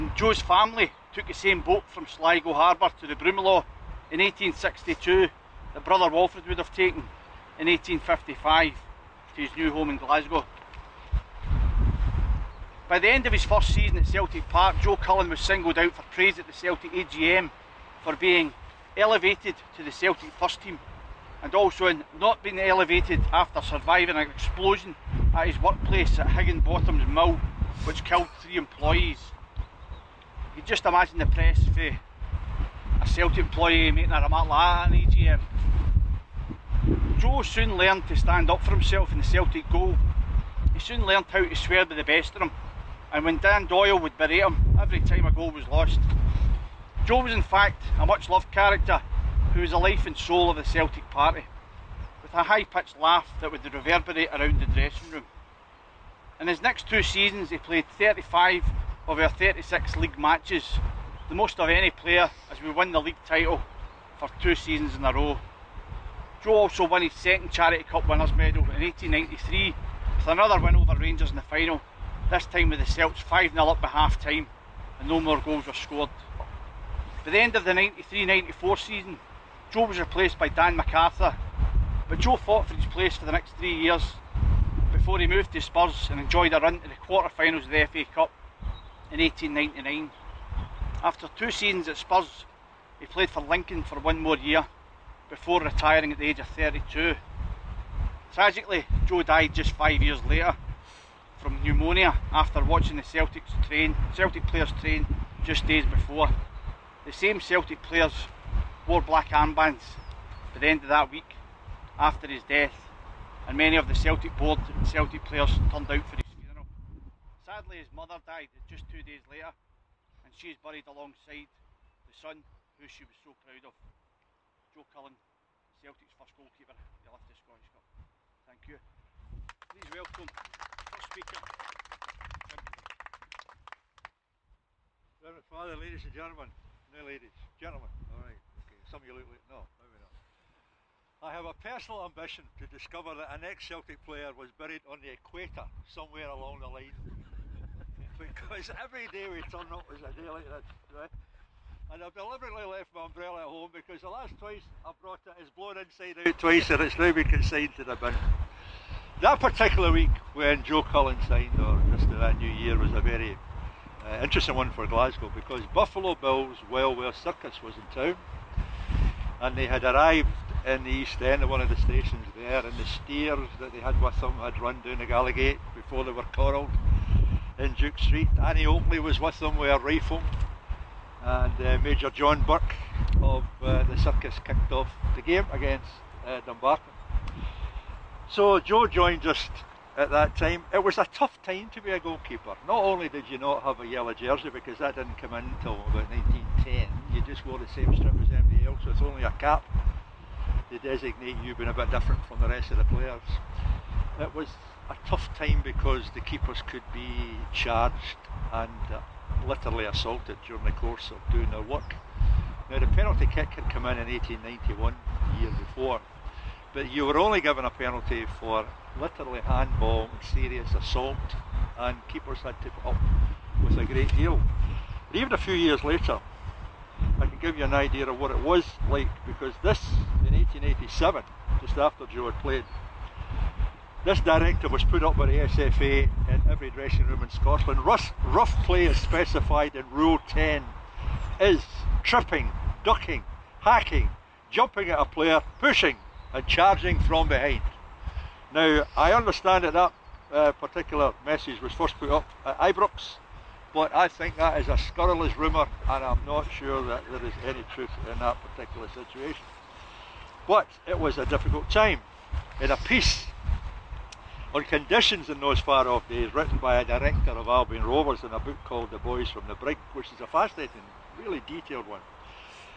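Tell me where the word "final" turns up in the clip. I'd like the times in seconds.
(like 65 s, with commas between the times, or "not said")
71 s, 86 s.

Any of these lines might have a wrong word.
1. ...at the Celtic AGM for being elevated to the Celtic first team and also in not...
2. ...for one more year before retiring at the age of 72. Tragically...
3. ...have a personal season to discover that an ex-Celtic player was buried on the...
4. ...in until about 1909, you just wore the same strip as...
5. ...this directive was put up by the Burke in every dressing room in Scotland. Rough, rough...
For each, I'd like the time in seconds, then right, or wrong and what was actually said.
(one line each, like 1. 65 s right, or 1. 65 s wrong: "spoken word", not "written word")
1. 16 s right
2. 93 s wrong: "32", not "72"
3. 141 s wrong: "ambition", not "season"
4. 195 s wrong: "1910", not "1909"
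5. 234 s wrong: "SFA", not "Burke".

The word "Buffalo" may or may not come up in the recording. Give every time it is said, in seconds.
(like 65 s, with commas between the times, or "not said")
165 s.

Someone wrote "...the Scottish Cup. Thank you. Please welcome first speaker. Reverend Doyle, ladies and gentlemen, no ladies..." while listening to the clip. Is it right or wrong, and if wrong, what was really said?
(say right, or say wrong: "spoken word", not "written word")
wrong: "Father", not "Doyle".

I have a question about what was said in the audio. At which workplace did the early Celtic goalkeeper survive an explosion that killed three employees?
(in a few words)
Higginbotham's mill.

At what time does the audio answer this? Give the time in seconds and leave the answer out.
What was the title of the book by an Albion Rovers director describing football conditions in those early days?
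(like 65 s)
268 s.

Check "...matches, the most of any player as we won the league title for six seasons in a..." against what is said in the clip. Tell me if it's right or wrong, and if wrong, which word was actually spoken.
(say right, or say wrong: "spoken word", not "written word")
wrong: "two", not "six".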